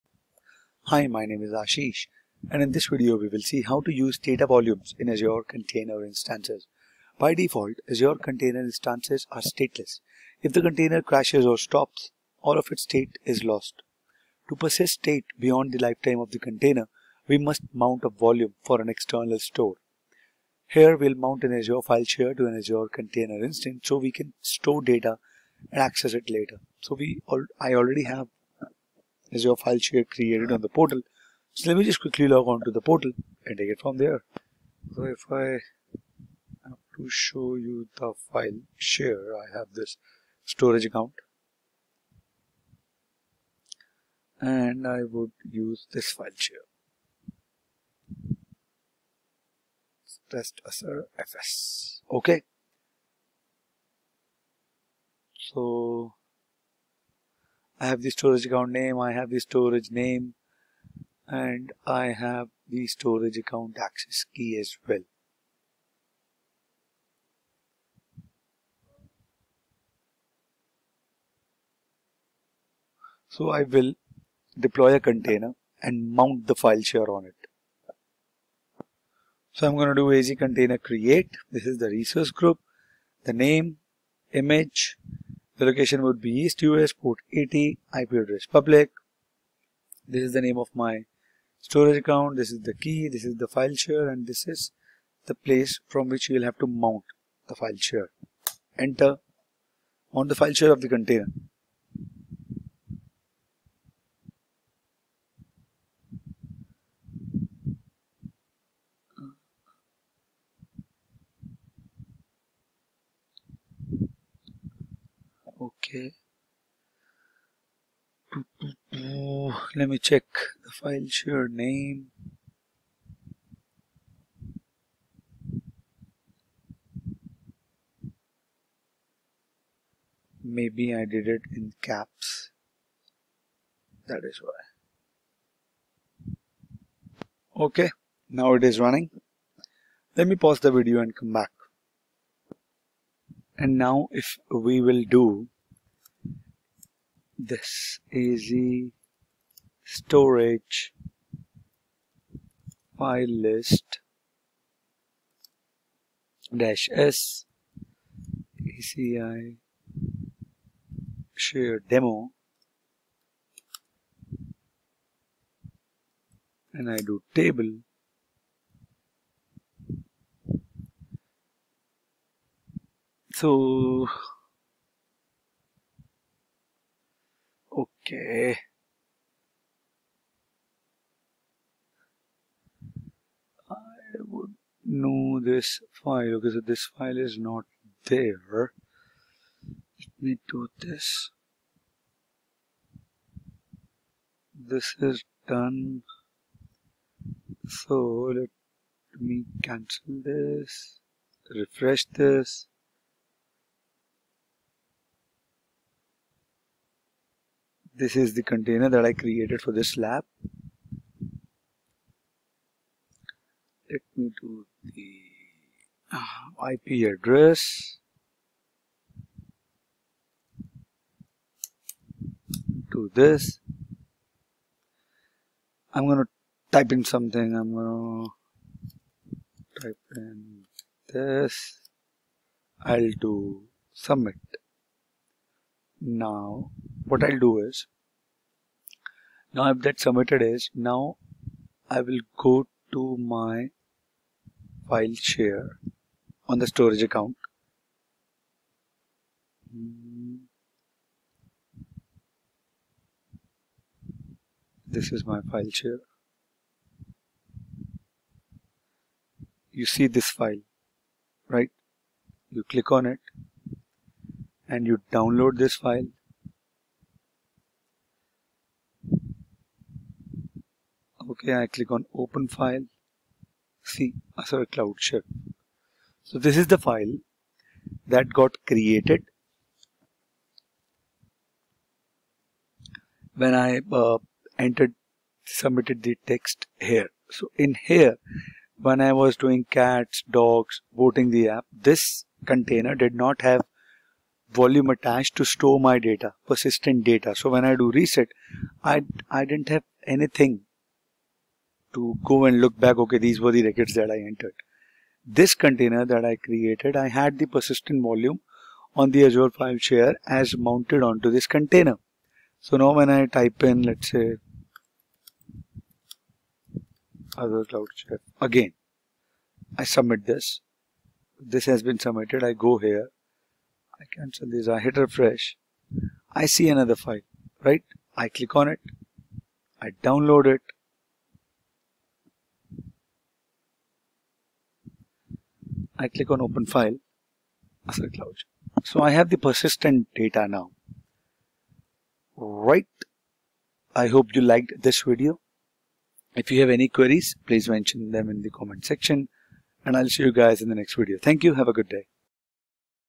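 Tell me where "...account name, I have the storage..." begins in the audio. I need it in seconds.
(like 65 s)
58 s.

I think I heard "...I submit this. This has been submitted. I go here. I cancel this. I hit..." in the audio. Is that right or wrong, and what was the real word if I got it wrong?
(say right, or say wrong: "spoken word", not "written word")
right.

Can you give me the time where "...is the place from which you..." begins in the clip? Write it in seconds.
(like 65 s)
94 s.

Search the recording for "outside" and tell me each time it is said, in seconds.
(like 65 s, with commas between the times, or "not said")
not said.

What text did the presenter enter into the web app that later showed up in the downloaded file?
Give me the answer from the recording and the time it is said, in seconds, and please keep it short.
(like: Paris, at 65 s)
Azure Cloud Chef, at 274 s.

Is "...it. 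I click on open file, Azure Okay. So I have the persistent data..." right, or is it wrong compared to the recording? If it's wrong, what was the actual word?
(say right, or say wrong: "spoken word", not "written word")
wrong: "Cloud", not "Okay".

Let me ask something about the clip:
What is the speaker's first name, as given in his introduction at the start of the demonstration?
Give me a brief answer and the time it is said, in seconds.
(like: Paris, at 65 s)
Ashish, at 1 s.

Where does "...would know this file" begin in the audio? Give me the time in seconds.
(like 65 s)
184 s.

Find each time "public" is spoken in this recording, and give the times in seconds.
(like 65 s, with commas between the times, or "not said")
88 s.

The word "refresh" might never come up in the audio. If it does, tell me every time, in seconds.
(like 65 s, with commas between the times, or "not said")
201 s, 324 s.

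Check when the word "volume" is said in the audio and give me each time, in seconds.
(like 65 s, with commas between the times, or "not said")
4 s, 18 s, 294 s, 308 s.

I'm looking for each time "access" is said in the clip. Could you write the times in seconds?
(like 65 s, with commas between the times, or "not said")
25 s, 63 s.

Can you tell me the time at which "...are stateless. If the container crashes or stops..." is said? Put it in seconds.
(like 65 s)
9 s.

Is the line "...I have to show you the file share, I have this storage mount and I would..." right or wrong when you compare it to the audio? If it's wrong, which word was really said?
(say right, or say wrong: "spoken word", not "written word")
wrong: "account", not "mount".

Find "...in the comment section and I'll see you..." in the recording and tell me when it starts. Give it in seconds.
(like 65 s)
348 s.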